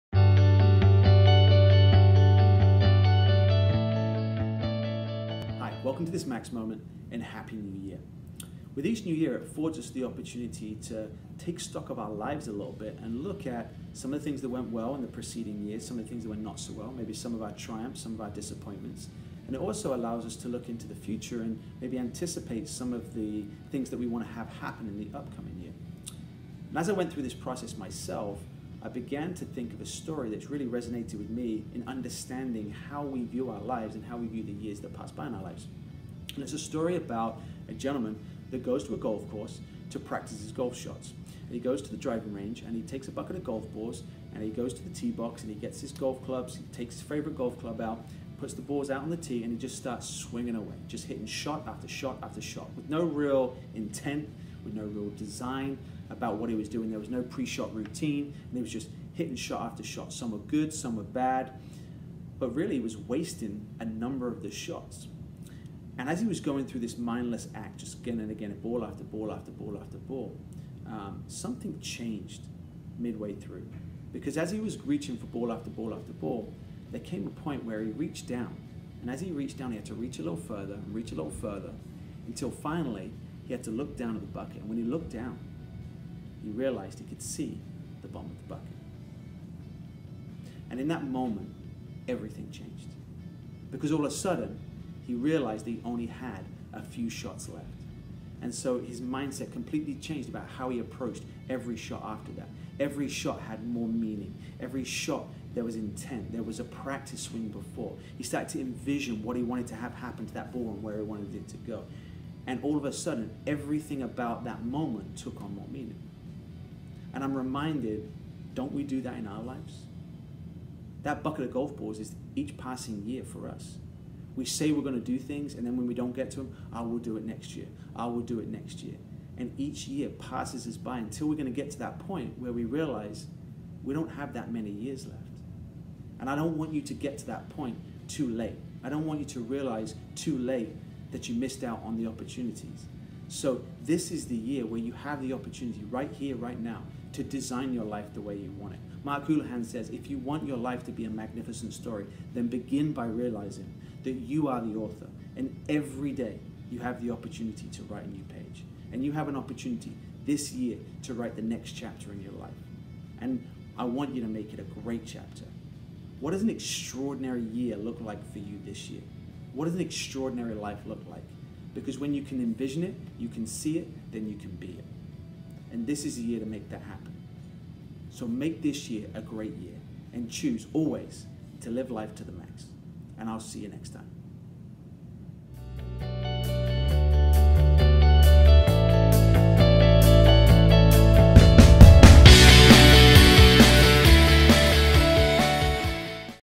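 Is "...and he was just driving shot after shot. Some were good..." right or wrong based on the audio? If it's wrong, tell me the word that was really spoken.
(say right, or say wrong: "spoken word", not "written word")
wrong: "hitting", not "driving".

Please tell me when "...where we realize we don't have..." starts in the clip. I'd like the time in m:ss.
2:12.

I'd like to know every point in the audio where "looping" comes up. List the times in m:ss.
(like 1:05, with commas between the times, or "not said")
not said.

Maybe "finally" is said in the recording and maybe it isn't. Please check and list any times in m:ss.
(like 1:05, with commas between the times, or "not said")
1:22.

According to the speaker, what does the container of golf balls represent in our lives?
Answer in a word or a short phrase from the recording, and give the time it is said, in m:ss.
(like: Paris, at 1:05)
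Each passing year, at 2:02.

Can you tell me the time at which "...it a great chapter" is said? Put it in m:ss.
2:44.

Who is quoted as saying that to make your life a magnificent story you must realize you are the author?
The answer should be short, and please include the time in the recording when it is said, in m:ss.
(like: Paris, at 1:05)
Mark Houlahan, at 2:29.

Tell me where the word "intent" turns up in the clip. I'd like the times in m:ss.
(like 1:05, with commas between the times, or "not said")
0:53, 1:45.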